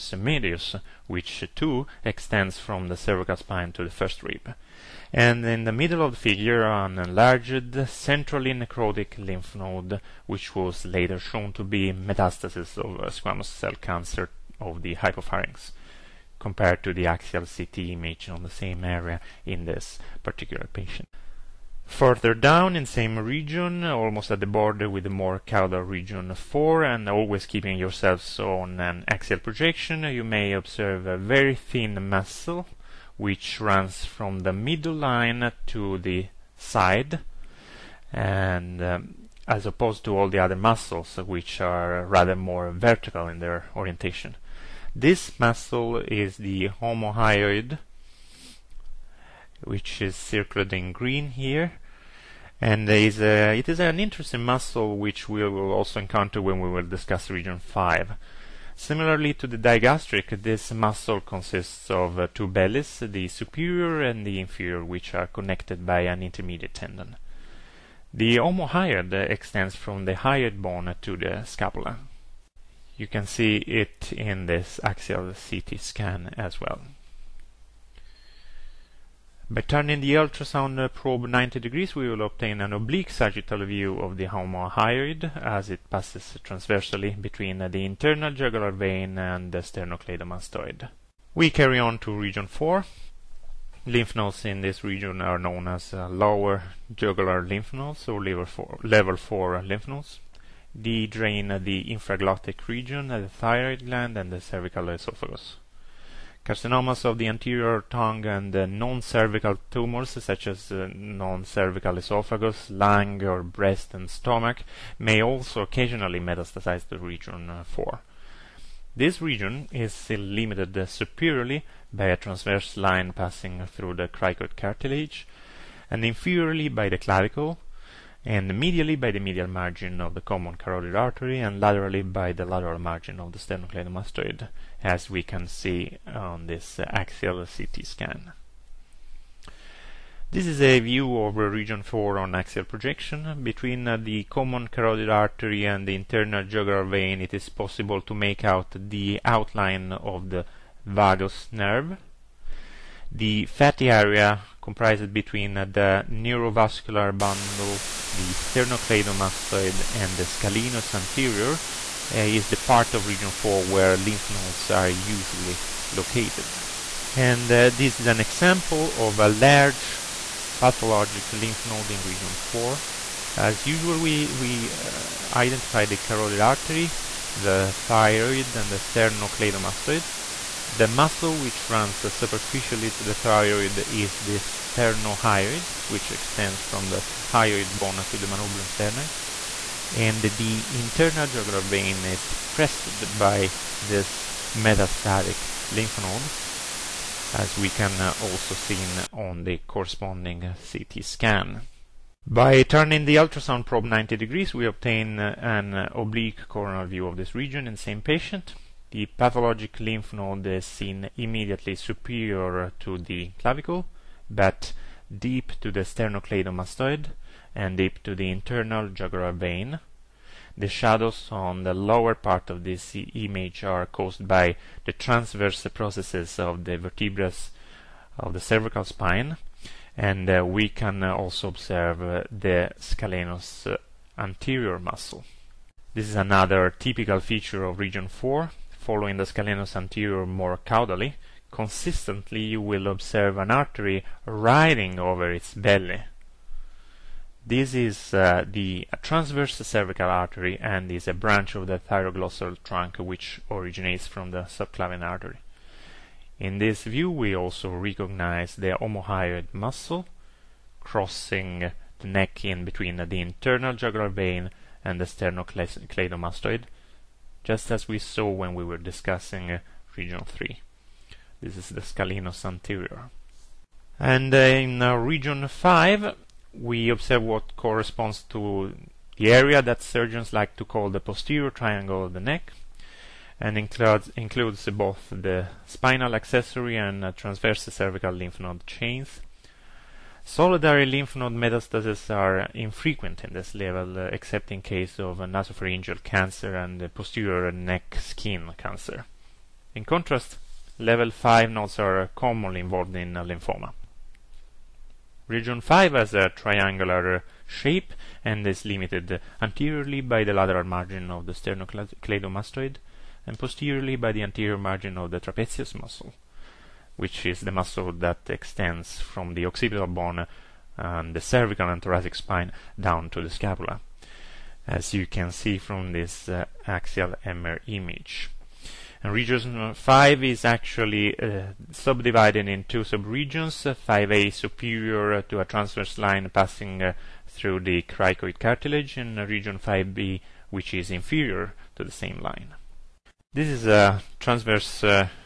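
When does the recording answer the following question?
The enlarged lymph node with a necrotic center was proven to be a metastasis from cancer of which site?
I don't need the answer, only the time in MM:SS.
00:14.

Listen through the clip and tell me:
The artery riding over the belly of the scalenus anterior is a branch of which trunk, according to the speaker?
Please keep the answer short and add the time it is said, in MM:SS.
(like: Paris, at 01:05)
Thyroglossal trunk, at 04:11.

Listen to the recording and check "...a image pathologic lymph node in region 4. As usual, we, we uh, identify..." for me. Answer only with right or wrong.
wrong.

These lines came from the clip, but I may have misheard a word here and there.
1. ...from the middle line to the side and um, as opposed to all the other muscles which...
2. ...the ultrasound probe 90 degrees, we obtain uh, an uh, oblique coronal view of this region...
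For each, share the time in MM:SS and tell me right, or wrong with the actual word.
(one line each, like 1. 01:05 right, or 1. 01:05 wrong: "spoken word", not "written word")
1. 00:34 right
2. 03:23 right.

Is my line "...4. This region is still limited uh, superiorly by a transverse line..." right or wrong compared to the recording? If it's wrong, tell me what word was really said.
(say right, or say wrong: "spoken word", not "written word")
right.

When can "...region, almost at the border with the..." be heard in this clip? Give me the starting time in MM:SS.
00:23.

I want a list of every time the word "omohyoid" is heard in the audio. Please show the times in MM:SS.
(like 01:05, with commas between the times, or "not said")
00:46, 01:08, 01:24, 04:18.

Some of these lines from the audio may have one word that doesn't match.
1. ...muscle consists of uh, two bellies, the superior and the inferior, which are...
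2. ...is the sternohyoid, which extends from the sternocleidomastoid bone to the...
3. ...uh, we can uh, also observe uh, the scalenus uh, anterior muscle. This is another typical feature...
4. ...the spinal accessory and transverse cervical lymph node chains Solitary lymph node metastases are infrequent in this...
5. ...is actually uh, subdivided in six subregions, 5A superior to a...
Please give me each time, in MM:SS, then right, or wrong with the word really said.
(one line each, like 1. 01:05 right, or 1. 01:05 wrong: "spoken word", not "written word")
1. 01:00 right
2. 03:03 wrong: "hyoid", not "sternocleidomastoid"
3. 03:50 right
4. 04:45 right
5. 05:30 wrong: "two", not "six".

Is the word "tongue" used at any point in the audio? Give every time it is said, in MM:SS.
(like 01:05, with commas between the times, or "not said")
01:47.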